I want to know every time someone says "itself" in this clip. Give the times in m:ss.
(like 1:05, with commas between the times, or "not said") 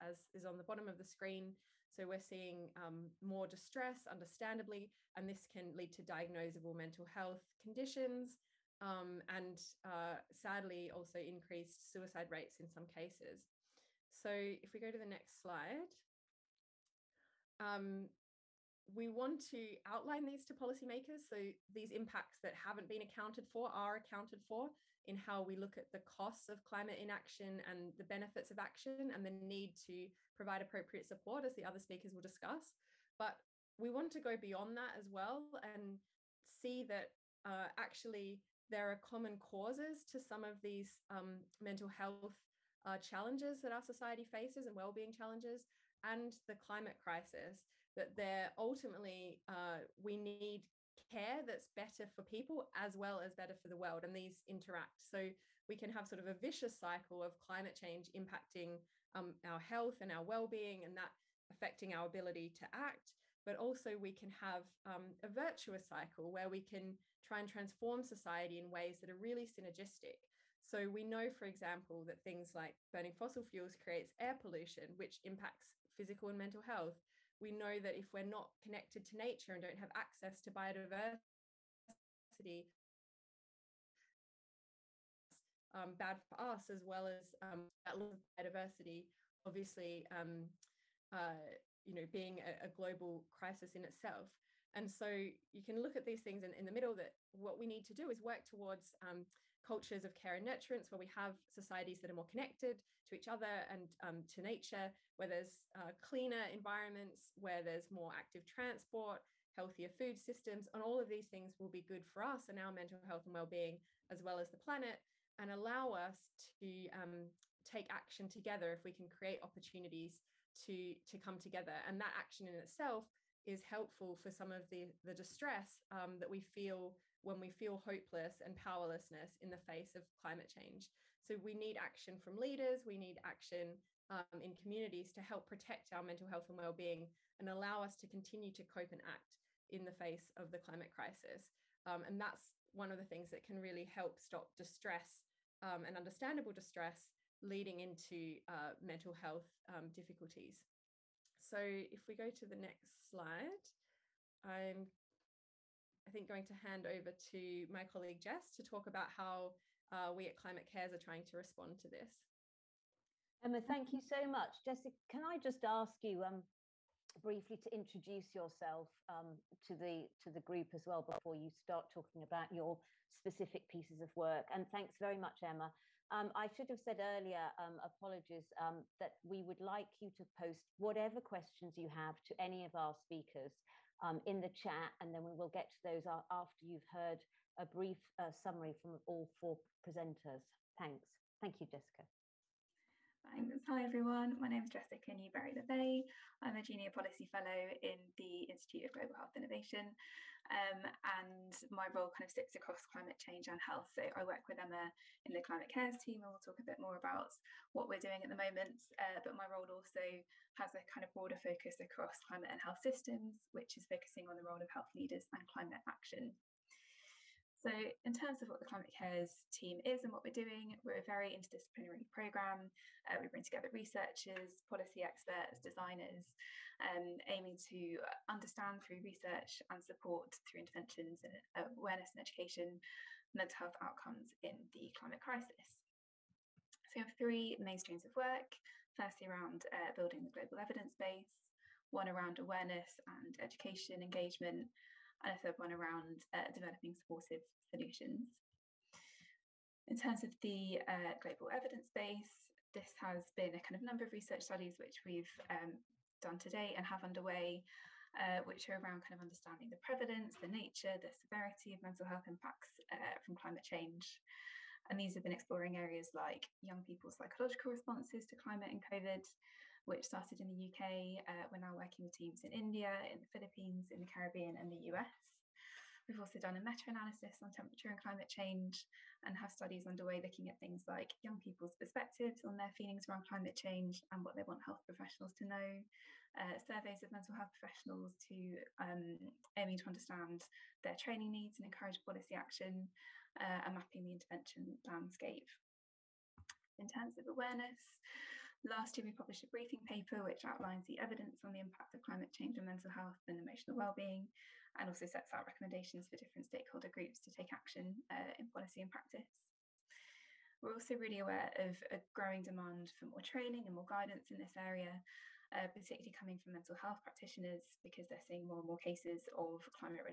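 1:33, 2:02.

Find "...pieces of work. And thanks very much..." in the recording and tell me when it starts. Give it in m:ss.
2:53.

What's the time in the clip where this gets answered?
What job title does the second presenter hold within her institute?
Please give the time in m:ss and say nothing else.
3:16.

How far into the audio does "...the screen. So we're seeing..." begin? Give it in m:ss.
0:00.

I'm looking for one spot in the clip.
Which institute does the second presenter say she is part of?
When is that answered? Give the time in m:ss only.
3:18.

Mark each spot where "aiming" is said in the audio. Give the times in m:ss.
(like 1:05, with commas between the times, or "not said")
3:47, 4:49.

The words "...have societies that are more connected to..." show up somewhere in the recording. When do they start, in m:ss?
1:41.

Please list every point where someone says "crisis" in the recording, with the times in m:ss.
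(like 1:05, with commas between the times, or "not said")
0:46, 1:33, 2:20, 3:55.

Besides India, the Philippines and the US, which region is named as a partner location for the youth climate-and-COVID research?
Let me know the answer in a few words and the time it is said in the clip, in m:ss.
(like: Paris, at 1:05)
the Caribbean, at 4:34.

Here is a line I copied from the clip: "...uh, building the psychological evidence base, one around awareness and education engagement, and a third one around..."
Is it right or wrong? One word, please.
wrong.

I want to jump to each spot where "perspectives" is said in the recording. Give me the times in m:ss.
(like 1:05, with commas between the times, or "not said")
4:41.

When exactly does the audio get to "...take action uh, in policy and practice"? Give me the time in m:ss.
5:07.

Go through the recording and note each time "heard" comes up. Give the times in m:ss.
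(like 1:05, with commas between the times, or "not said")
3:06.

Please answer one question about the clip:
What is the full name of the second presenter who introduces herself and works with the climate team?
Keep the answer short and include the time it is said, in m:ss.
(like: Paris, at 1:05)
Jessica Newberry Le Vay, at 3:14.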